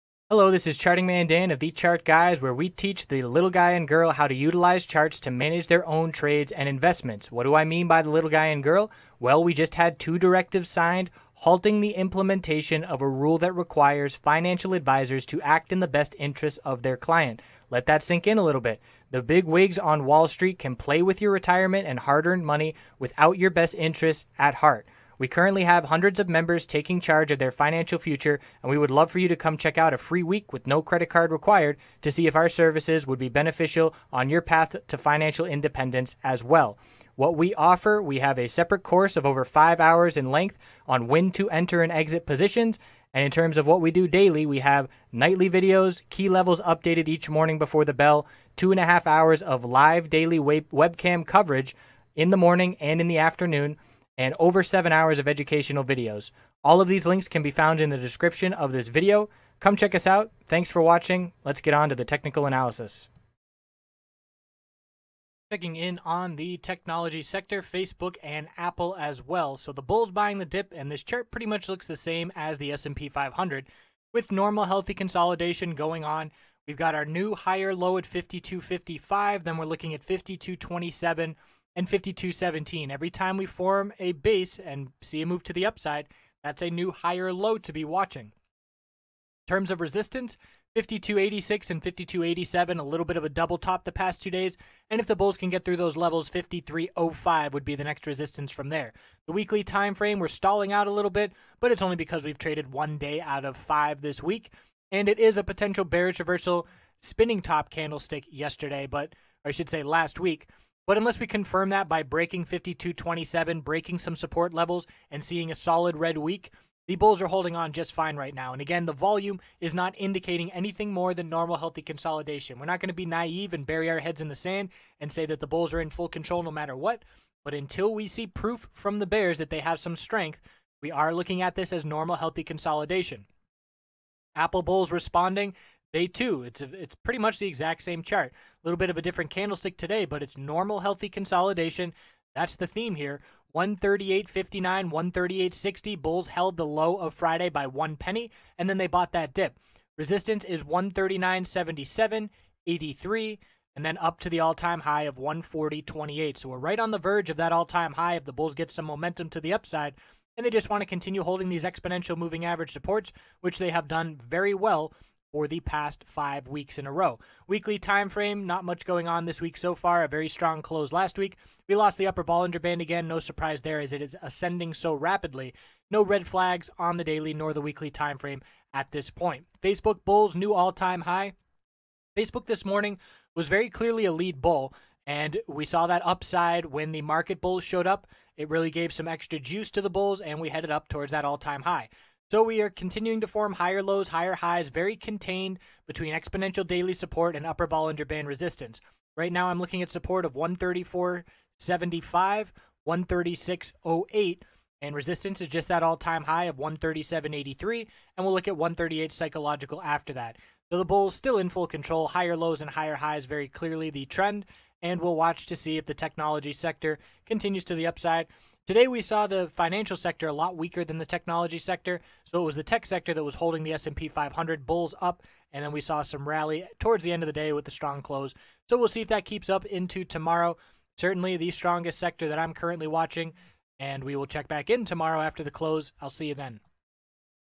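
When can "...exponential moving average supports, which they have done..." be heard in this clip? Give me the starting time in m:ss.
2:41.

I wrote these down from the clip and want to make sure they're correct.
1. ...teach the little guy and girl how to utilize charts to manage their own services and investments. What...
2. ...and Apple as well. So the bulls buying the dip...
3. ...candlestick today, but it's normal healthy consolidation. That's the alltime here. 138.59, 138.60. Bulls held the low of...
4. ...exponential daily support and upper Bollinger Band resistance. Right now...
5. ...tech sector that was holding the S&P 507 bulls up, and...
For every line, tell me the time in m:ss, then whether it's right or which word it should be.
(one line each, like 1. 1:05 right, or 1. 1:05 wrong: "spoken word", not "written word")
1. 0:02 wrong: "trades", not "services"
2. 1:08 right
3. 2:19 wrong: "theme", not "alltime"
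4. 3:16 right
5. 3:42 wrong: "500", not "507".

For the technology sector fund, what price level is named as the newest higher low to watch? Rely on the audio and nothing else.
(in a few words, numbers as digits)
52.55.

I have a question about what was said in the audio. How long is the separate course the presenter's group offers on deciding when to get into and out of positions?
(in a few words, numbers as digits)
over 5 hours.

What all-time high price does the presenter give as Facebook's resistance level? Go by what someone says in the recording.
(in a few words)
137.83.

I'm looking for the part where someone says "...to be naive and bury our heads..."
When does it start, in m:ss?
2:02.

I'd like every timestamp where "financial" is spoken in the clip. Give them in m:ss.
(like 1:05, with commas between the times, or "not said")
0:14, 0:27, 0:34, 3:39.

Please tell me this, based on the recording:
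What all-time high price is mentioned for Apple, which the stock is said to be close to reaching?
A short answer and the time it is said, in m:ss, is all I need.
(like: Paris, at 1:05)
140.28, at 2:35.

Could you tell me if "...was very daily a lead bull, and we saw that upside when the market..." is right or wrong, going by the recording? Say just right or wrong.
wrong.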